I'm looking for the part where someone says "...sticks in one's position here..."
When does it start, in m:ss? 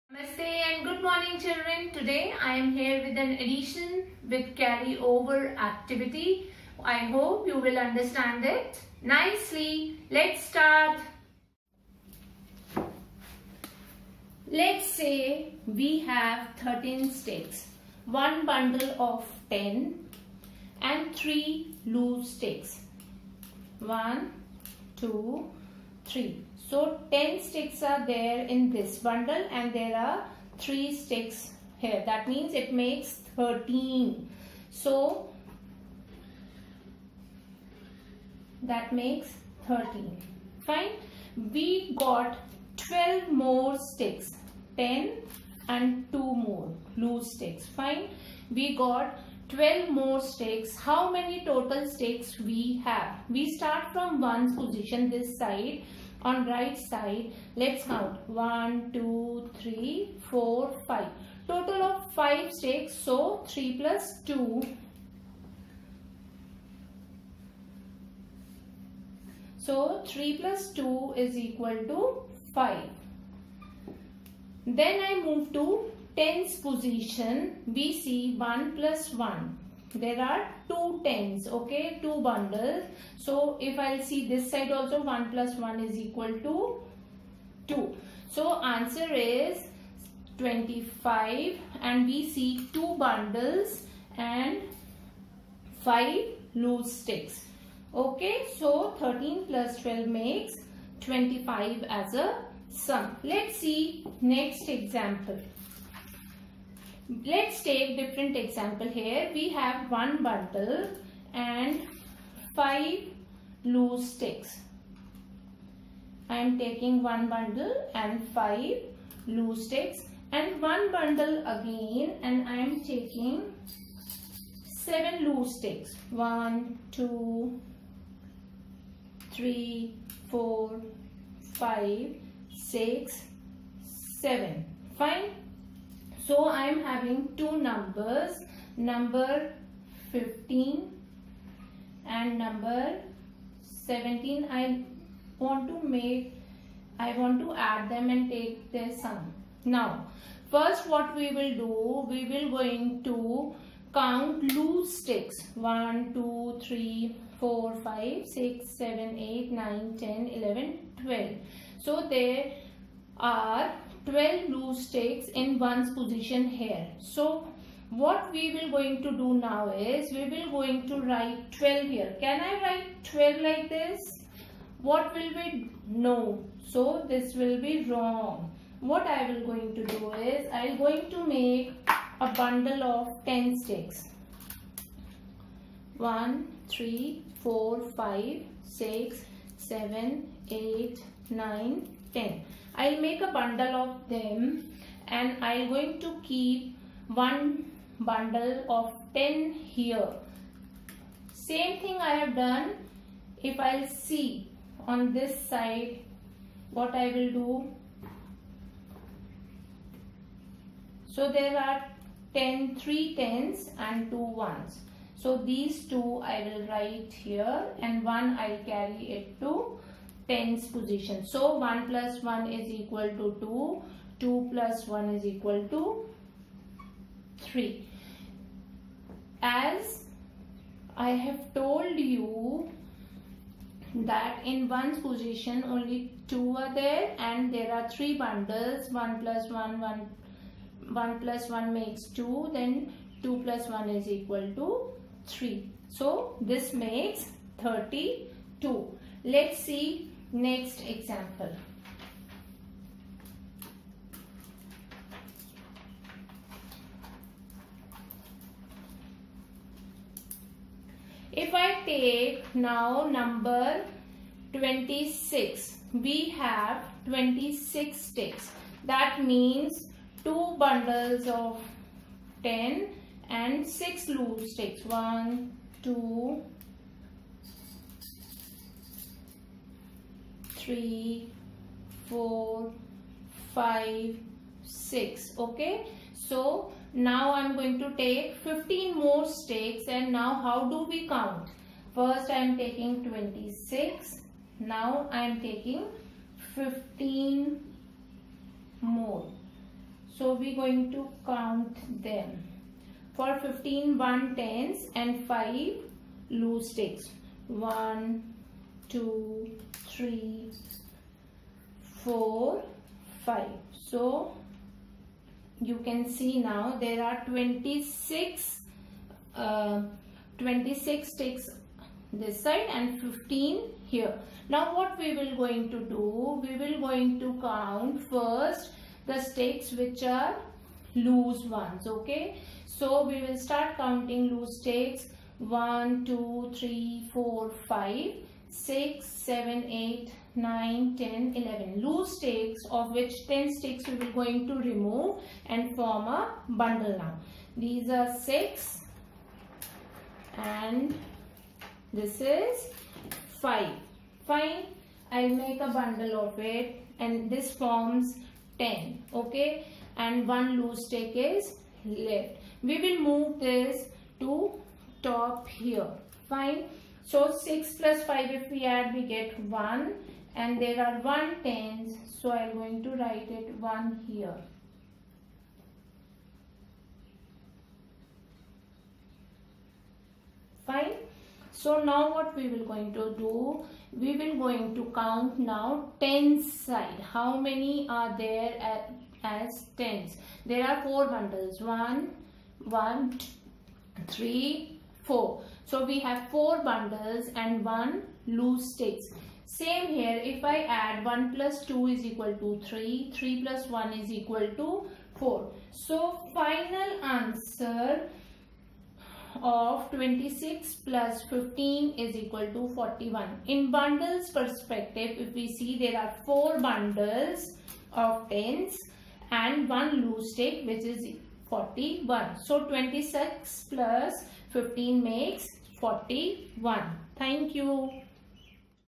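2:44.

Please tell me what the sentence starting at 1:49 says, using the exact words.
We have one bundle and five loose sticks.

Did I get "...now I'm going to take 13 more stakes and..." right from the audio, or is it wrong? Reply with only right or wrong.
wrong.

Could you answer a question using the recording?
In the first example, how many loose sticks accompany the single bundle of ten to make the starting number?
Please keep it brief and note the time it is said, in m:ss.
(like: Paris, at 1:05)
3, at 0:21.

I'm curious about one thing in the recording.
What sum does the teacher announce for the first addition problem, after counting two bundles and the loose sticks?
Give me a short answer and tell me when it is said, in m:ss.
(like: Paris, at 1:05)
25, at 1:28.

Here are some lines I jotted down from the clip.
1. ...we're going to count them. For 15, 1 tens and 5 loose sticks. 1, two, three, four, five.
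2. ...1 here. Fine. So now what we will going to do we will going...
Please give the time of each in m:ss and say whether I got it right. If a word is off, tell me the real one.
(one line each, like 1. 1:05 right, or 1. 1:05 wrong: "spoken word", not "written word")
1. 5:00 right
2. 6:13 right.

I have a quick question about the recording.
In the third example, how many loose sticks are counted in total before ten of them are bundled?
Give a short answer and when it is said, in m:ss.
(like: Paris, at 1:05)
11, at 5:41.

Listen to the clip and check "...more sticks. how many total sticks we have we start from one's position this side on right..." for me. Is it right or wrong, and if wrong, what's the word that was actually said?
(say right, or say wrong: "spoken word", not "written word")
right.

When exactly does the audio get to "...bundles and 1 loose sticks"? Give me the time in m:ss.
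6:36.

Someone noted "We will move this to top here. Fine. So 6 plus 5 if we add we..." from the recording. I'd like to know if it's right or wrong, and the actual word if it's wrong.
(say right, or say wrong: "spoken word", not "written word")
right.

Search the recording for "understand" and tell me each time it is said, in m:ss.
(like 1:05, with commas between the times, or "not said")
0:07.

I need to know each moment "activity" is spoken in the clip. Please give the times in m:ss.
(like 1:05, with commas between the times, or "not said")
0:05.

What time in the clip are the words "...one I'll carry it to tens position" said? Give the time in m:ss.
3:38.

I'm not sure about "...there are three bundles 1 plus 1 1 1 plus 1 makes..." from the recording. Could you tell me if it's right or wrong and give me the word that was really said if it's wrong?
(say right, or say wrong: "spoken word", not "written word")
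right.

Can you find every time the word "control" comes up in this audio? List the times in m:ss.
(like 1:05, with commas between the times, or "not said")
not said.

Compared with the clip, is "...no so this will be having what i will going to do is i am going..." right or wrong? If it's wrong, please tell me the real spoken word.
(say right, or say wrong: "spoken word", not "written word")
wrong: "wrong", not "having".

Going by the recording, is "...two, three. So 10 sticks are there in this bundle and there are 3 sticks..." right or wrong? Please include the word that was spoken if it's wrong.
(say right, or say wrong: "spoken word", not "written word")
right.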